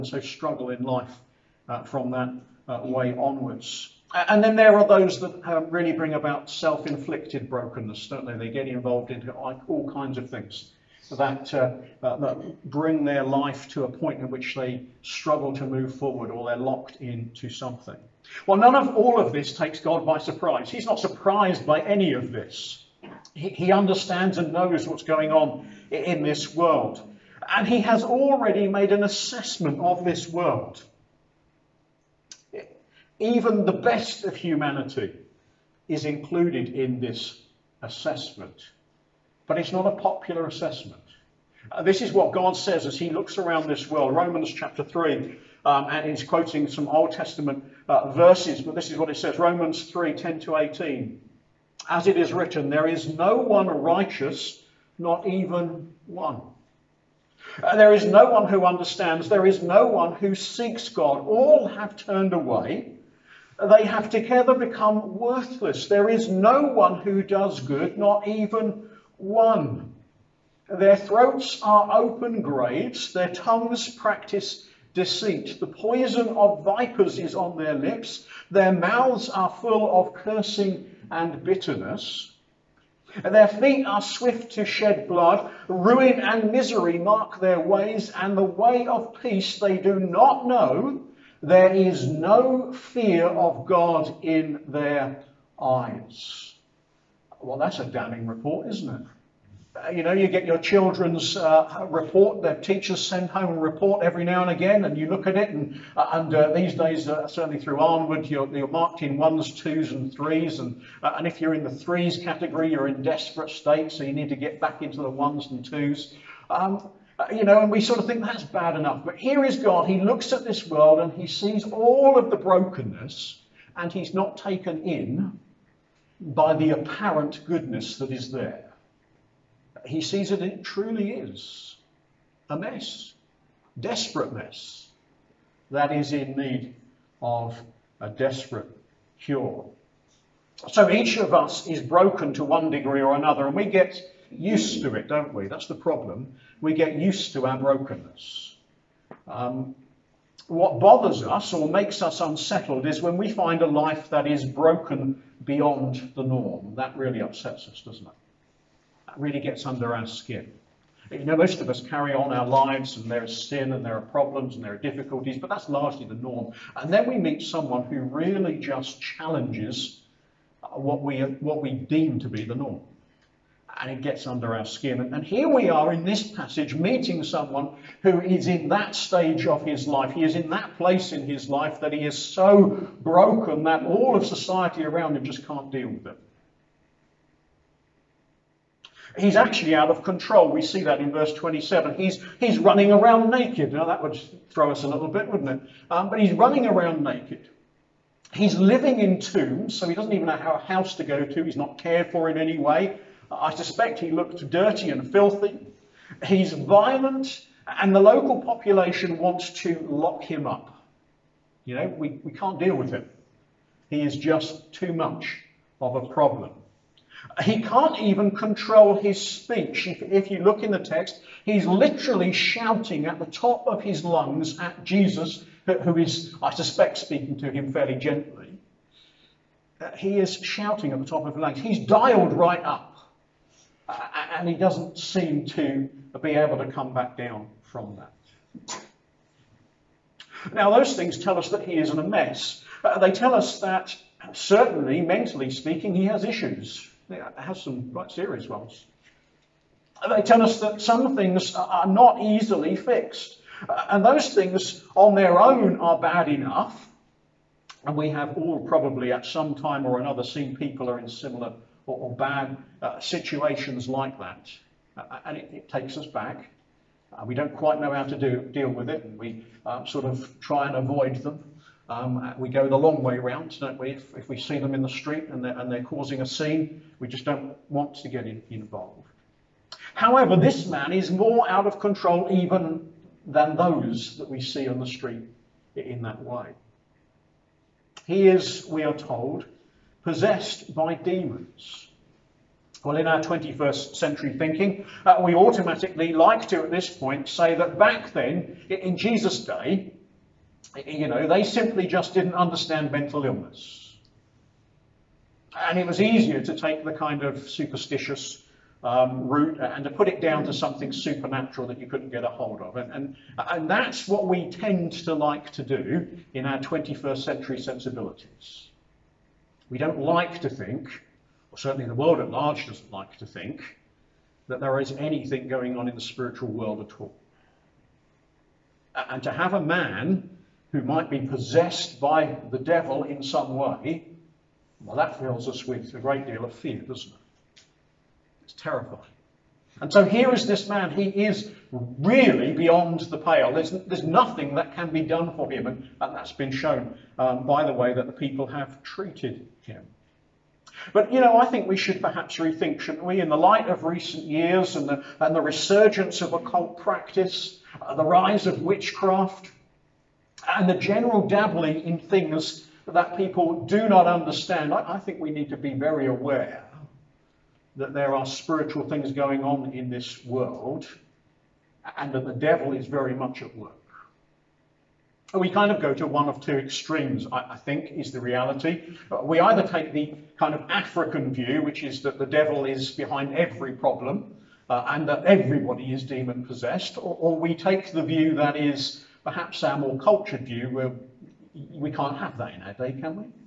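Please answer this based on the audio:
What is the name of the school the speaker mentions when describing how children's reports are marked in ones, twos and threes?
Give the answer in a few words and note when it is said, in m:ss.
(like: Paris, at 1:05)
Arnwood, at 1:47.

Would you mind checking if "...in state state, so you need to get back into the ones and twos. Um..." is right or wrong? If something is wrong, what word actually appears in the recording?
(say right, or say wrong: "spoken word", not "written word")
wrong: "desperate", not "state".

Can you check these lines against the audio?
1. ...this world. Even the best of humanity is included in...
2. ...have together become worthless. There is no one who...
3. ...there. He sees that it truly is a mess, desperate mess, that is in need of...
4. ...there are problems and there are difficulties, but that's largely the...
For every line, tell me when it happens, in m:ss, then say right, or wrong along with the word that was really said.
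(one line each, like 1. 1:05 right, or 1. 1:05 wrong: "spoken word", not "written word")
1. 0:30 right
2. 1:03 right
3. 2:08 right
4. 2:43 right.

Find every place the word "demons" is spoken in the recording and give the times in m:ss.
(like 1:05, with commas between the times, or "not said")
4:50, 6:26.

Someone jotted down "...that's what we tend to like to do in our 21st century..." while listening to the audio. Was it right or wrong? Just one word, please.
right.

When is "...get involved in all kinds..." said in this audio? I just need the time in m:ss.
0:08.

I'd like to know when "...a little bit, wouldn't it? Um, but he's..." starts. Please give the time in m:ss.
3:14.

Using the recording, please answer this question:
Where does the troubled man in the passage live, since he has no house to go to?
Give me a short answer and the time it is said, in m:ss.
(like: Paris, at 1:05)
In tombs, at 3:19.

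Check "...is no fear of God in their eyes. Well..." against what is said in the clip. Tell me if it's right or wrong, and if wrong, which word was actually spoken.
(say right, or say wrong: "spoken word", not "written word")
right.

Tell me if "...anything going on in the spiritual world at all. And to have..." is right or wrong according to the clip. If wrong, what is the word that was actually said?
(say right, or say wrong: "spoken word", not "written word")
right.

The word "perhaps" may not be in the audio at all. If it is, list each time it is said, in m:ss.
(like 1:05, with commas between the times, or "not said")
5:52, 6:29.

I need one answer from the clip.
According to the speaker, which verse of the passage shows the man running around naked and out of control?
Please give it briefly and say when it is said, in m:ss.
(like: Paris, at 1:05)
Verse 27, at 3:11.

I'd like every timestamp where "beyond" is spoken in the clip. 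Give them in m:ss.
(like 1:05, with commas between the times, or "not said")
2:35, 5:42.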